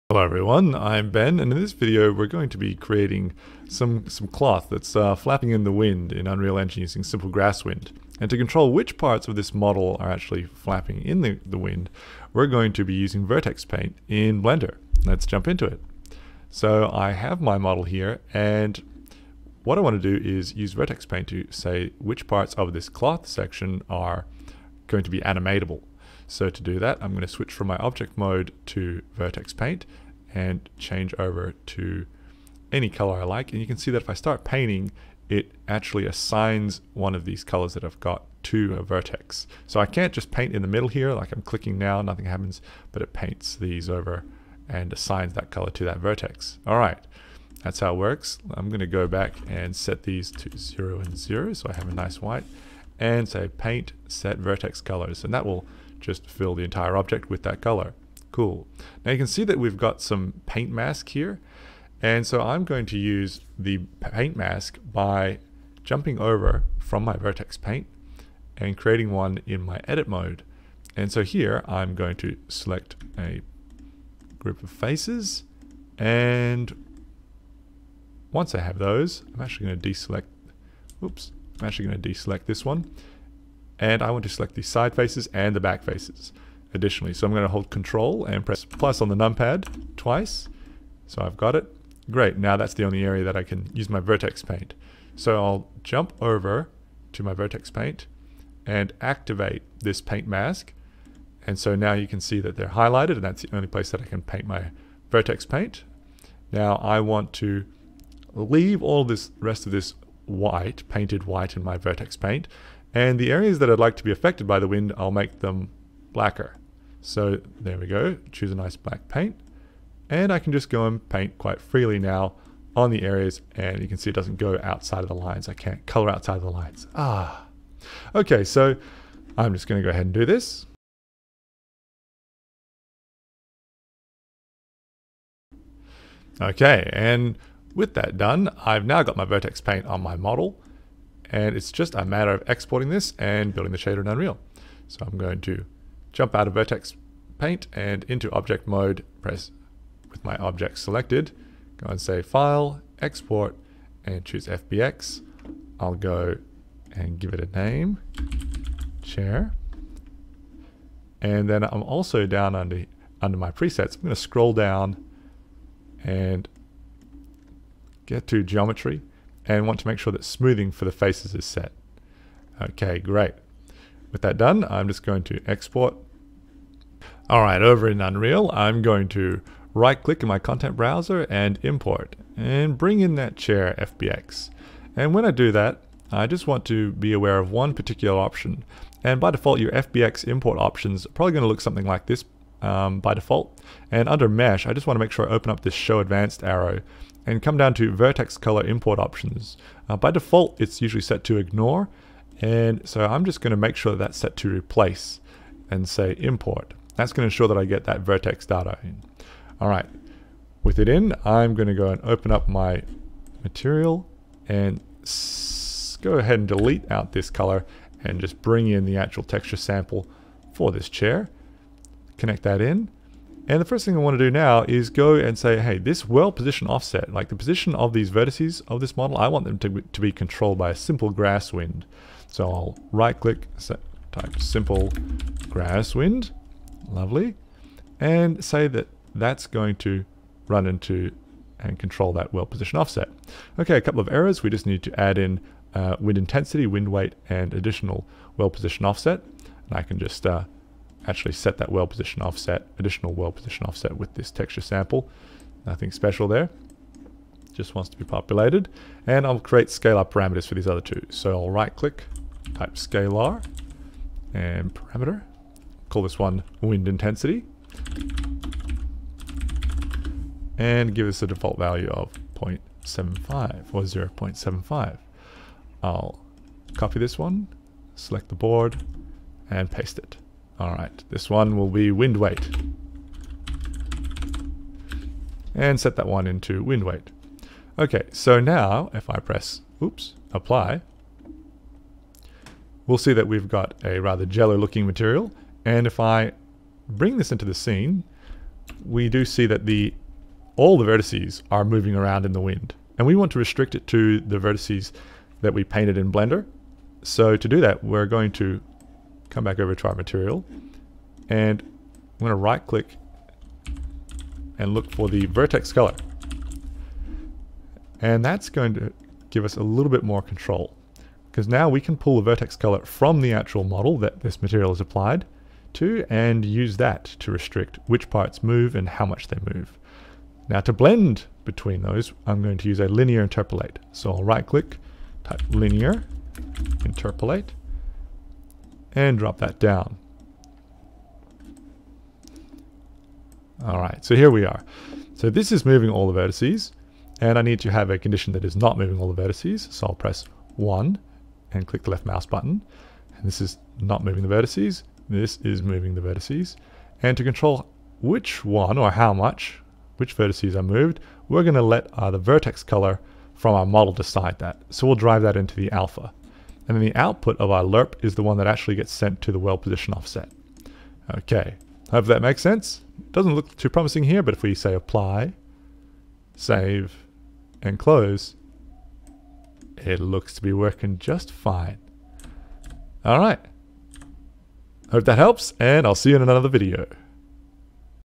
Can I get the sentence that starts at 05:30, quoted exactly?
Now to blend between those, I'm going to use a linear interpolate.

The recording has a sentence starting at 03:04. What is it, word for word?
And when I do that, I just want to be aware of one particular option.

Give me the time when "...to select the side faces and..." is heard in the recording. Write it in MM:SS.
01:24.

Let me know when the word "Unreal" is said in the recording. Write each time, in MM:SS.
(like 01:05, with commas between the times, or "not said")
00:06, 02:24, 02:58.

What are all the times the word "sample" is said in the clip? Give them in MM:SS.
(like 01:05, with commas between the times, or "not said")
03:39, 04:14.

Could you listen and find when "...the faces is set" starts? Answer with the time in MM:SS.
02:50.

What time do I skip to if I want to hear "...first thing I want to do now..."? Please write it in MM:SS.
03:43.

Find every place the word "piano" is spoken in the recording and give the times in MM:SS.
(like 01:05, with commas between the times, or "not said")
not said.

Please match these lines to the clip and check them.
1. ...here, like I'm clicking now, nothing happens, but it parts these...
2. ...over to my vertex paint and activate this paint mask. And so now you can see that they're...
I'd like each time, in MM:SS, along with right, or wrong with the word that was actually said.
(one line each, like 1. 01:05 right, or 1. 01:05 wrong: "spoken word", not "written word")
1. 00:40 wrong: "paints", not "parts"
2. 01:36 right.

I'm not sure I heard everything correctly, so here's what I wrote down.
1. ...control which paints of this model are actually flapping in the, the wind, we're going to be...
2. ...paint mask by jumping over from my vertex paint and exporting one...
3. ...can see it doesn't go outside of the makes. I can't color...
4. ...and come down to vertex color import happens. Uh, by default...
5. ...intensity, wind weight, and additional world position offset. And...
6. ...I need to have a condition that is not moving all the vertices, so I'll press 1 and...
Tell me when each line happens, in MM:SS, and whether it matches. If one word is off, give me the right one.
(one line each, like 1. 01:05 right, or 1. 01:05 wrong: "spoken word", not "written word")
1. 00:08 wrong: "parts", not "paints"
2. 01:03 wrong: "creating", not "exporting"
3. 02:03 wrong: "lines", not "makes"
4. 03:17 wrong: "options", not "happens"
5. 04:06 right
6. 05:47 right.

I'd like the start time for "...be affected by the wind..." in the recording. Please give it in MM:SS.
01:54.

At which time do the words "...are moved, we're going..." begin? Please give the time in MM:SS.
06:00.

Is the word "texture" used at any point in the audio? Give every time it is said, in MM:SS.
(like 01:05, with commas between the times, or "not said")
03:39, 04:14.